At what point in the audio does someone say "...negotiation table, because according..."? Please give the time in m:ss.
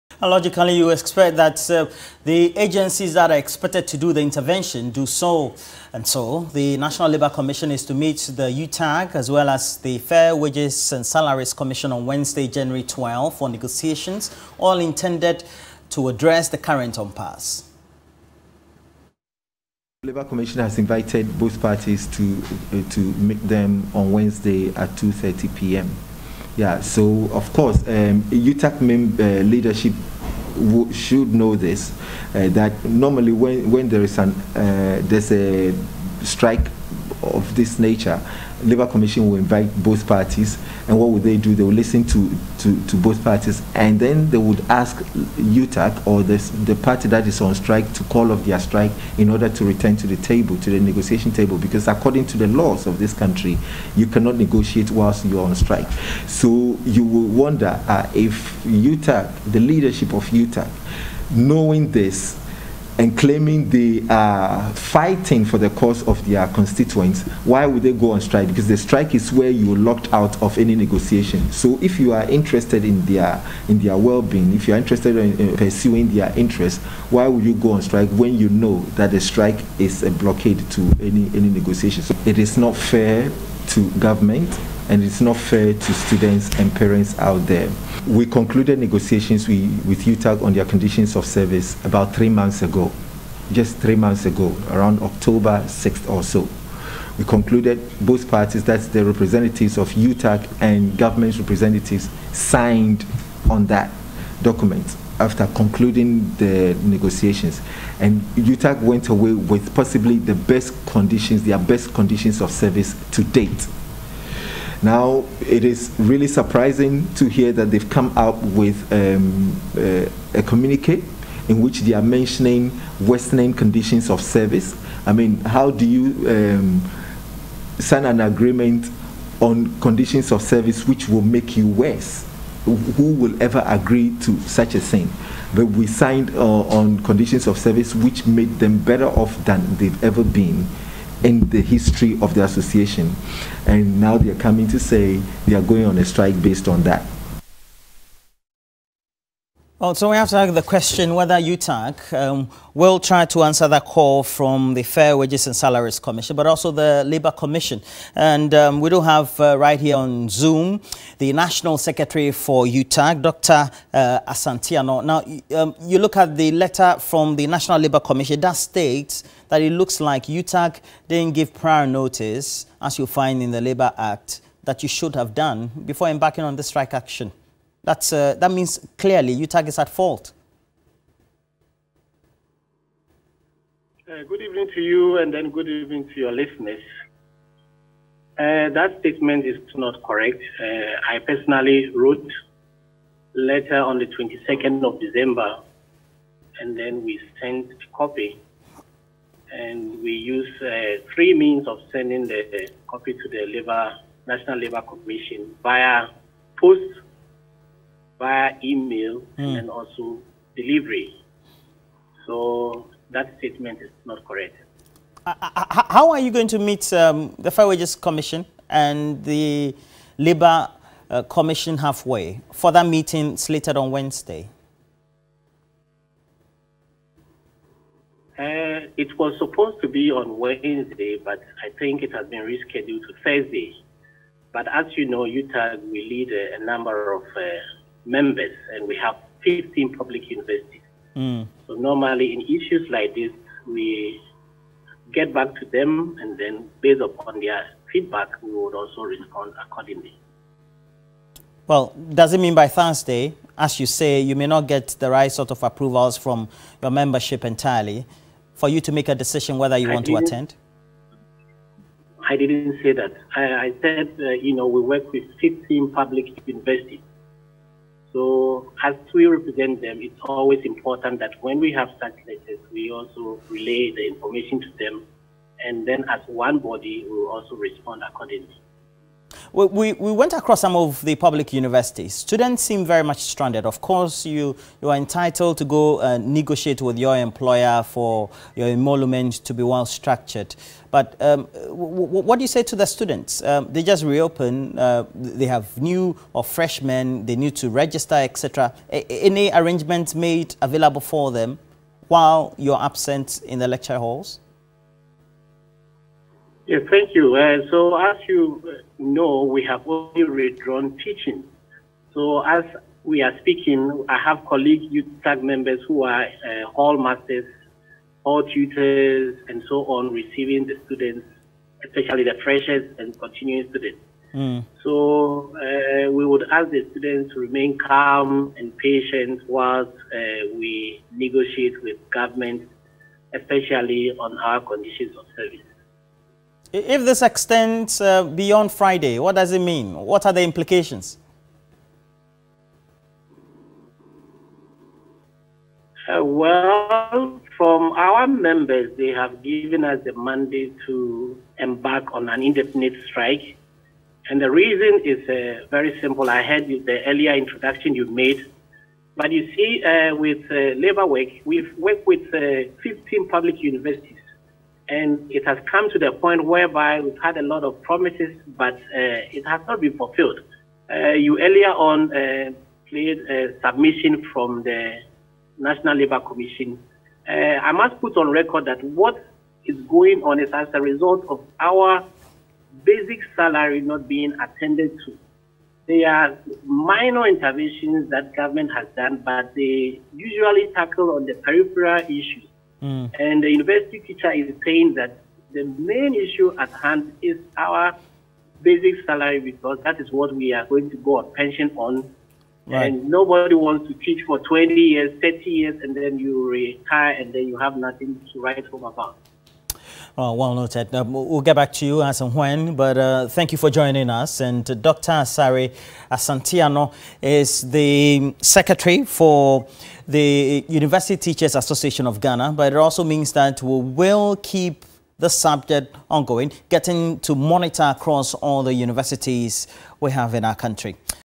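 0:50.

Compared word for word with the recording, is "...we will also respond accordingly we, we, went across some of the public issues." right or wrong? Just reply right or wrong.
wrong.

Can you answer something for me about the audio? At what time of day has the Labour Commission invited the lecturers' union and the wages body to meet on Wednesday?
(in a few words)
2:30 p.m.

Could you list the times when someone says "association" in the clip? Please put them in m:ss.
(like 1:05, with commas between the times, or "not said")
2:22, 7:01.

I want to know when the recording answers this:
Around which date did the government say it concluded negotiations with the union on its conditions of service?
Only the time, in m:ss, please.
1:35.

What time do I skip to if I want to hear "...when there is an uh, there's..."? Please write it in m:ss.
0:33.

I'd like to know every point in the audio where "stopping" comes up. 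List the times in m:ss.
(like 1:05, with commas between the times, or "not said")
not said.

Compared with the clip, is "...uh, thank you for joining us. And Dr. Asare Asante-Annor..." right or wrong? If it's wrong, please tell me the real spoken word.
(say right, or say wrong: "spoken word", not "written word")
right.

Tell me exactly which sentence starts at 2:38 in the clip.
And um, we do have uh, right here on Zoom the National Secretary for UTAG, Dr.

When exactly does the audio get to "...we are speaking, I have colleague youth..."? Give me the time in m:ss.
5:13.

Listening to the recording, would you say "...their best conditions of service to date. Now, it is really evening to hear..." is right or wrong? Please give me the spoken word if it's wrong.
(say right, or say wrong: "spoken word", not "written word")
wrong: "surprising", not "evening".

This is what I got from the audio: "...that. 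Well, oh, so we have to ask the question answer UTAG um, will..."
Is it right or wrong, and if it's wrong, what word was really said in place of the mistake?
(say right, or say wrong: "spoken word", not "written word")
wrong: "whether", not "answer".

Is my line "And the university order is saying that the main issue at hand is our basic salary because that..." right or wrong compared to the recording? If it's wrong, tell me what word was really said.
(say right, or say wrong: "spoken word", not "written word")
wrong: "teacher", not "order".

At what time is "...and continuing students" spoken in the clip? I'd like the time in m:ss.
5:22.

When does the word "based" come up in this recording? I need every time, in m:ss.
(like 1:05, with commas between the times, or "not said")
2:26, 4:06.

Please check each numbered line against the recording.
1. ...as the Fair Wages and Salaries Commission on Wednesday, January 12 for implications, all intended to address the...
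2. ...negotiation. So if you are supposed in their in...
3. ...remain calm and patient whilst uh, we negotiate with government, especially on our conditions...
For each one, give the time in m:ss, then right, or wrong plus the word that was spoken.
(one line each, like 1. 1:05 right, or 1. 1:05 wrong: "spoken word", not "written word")
1. 0:09 wrong: "negotiations", not "implications"
2. 1:10 wrong: "interested", not "supposed"
3. 5:27 right.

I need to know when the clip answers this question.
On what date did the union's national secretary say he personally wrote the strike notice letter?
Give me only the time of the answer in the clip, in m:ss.
3:14.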